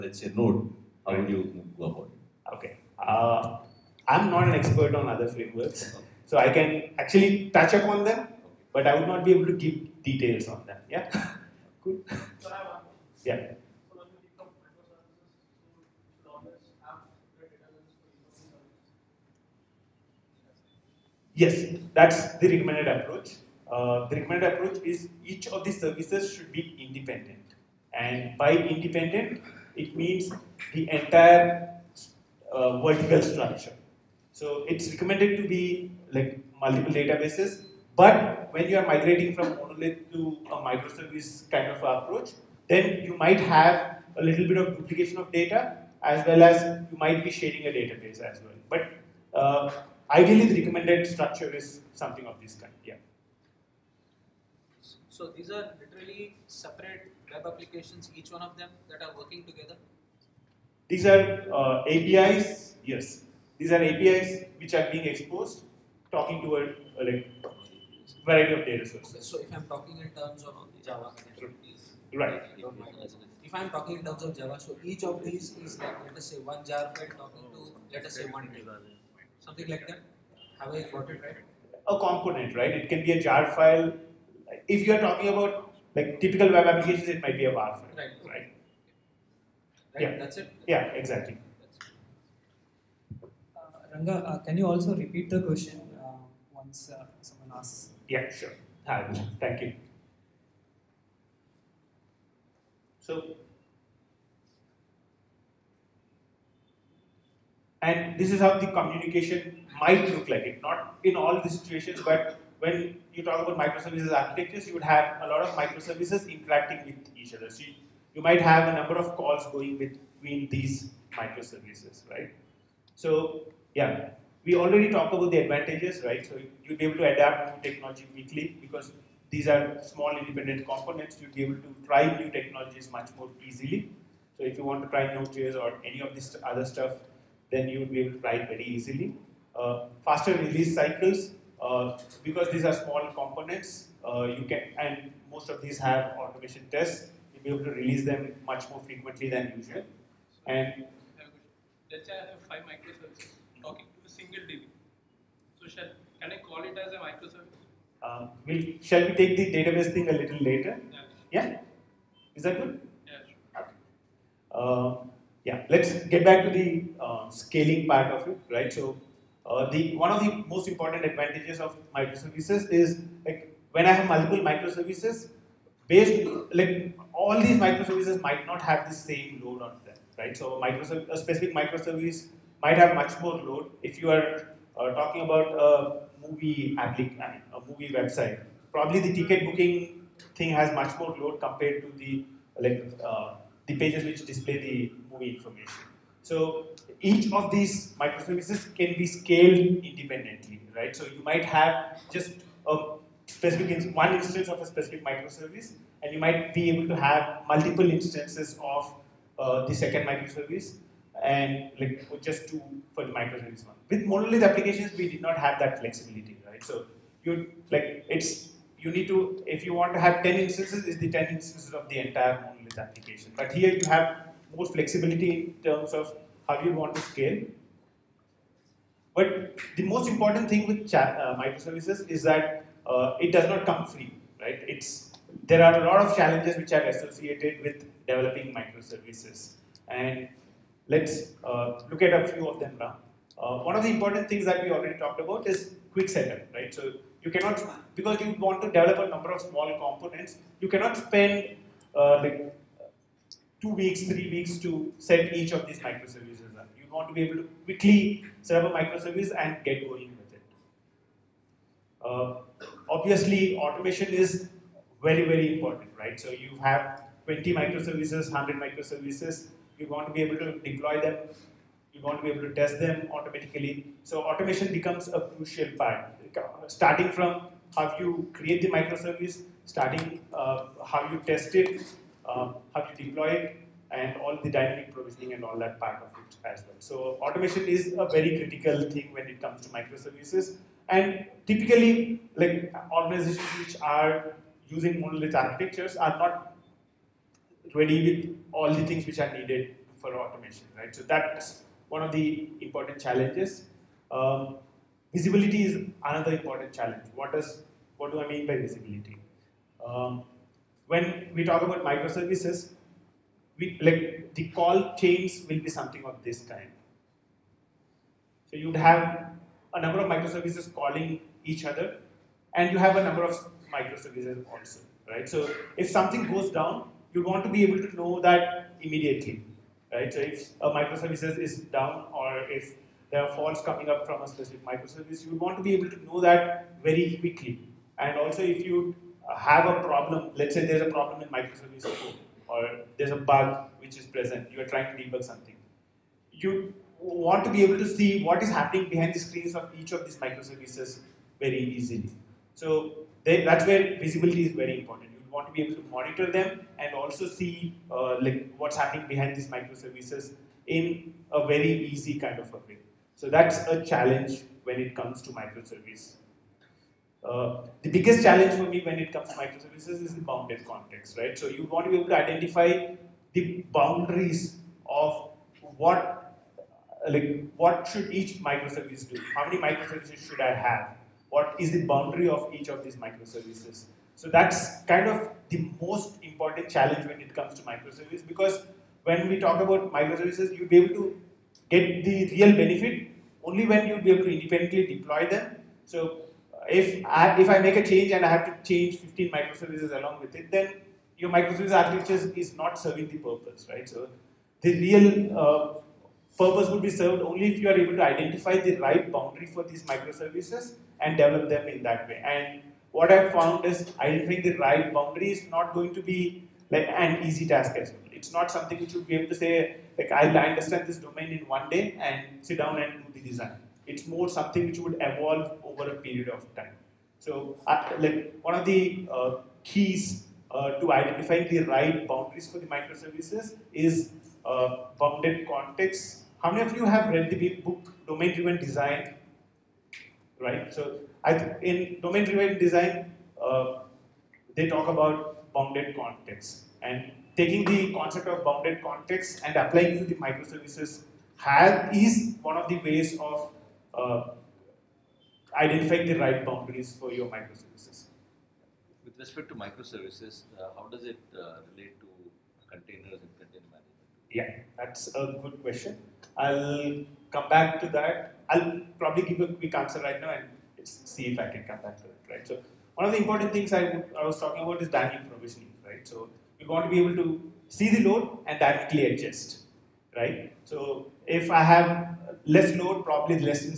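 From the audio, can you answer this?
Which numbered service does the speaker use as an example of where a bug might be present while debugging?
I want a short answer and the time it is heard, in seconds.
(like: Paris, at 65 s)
microservice 4, at 341 s.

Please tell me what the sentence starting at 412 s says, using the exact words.
And what I've found is identifying the right boundary is not going to be like an easy task as well.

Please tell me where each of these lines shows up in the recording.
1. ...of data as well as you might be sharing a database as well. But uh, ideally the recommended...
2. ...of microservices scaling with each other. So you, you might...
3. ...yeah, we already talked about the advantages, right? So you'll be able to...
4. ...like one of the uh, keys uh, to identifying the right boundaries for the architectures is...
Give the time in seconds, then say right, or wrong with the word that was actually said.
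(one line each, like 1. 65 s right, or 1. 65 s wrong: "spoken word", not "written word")
1. 45 s right
2. 115 s wrong: "interacting", not "scaling"
3. 123 s right
4. 427 s wrong: "microservices", not "architectures".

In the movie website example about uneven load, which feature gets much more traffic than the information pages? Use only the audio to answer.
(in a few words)
ticket booking.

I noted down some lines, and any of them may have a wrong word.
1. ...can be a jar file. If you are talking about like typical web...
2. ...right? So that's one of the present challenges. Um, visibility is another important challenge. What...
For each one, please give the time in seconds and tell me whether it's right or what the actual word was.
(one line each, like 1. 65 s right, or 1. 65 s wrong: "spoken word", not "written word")
1. 82 s right
2. 300 s wrong: "important", not "present".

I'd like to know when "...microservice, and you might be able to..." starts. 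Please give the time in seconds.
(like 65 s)
205 s.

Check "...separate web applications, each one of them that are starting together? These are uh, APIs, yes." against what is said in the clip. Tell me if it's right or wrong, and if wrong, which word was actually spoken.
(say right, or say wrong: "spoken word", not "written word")
wrong: "working", not "starting".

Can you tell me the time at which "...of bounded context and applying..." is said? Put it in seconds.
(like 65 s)
448 s.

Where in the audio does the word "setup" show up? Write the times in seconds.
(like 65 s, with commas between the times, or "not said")
246 s.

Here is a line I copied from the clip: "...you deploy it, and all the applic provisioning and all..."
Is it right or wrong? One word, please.
wrong.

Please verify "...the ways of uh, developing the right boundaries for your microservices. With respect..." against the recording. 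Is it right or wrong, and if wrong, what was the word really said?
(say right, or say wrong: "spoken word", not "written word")
wrong: "identifying", not "developing".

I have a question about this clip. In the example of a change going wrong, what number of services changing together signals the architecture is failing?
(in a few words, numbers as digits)
15.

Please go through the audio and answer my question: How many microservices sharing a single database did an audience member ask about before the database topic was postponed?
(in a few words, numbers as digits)
5.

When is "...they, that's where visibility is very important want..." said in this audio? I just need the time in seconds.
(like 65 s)
353 s.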